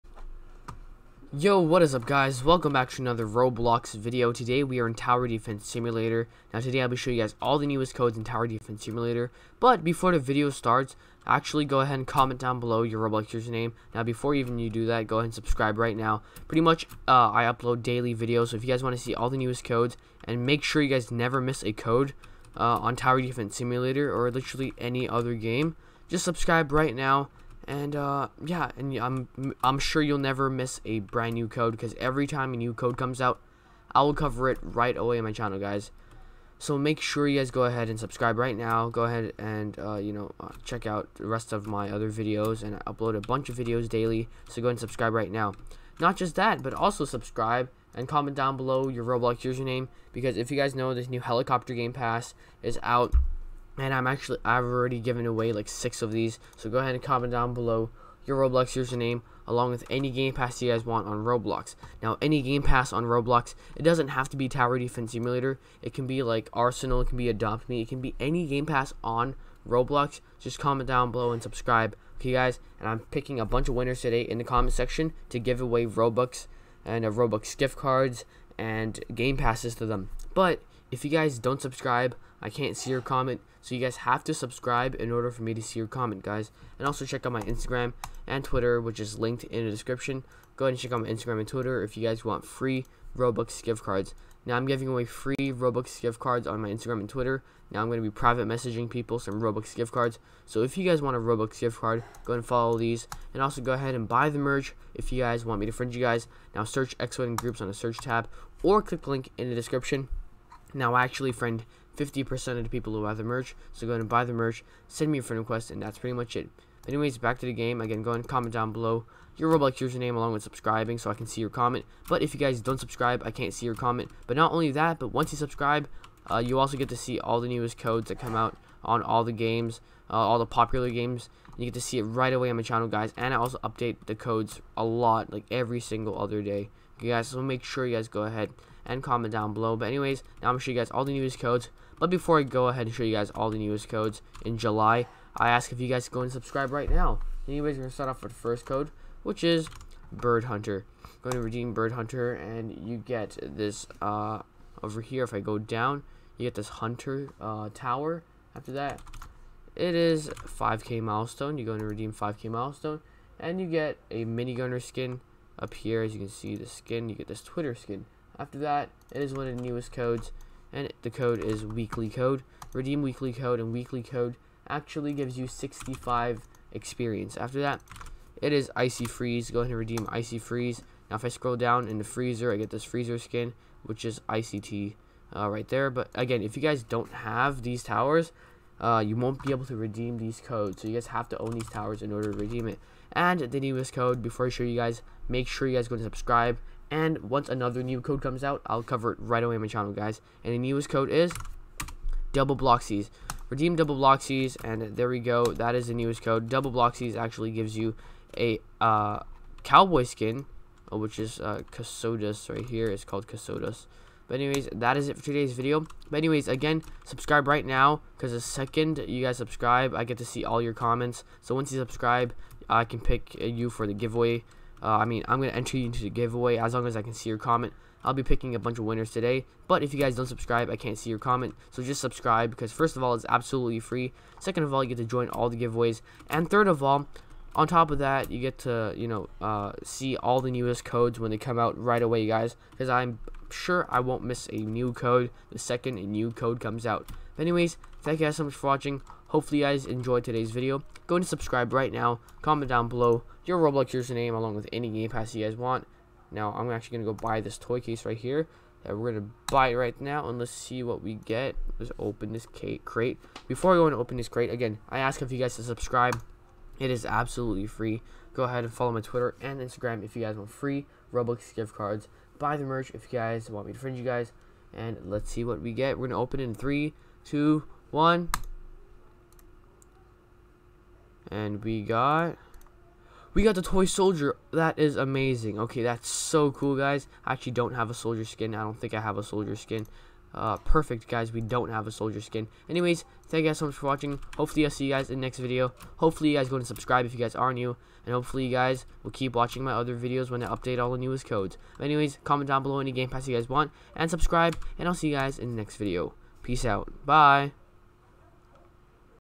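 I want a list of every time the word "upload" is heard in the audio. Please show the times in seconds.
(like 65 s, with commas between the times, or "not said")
17 s, 42 s.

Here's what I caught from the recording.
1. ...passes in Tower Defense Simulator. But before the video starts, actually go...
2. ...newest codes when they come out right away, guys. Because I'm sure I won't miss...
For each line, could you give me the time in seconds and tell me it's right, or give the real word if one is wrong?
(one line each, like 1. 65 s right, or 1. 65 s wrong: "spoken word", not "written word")
1. 7 s wrong: "codes", not "passes"
2. 240 s right.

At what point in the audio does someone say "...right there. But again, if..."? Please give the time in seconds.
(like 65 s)
185 s.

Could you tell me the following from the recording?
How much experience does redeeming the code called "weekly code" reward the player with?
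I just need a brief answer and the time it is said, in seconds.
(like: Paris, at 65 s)
65 experience, at 175 s.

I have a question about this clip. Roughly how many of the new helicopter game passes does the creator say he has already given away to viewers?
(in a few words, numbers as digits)
6.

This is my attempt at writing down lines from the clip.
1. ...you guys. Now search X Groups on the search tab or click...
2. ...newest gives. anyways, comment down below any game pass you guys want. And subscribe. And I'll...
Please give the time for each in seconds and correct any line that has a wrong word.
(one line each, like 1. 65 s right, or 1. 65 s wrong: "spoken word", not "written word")
1. 105 s right
2. 300 s wrong: "codes", not "gives".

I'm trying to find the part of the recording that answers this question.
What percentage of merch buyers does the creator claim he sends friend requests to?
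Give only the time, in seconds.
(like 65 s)
111 s.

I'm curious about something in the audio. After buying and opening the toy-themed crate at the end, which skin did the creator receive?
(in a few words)
toy soldier.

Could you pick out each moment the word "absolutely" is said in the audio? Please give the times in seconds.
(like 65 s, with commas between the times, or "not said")
233 s, 267 s.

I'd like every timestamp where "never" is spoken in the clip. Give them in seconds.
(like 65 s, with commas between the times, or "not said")
21 s, 30 s.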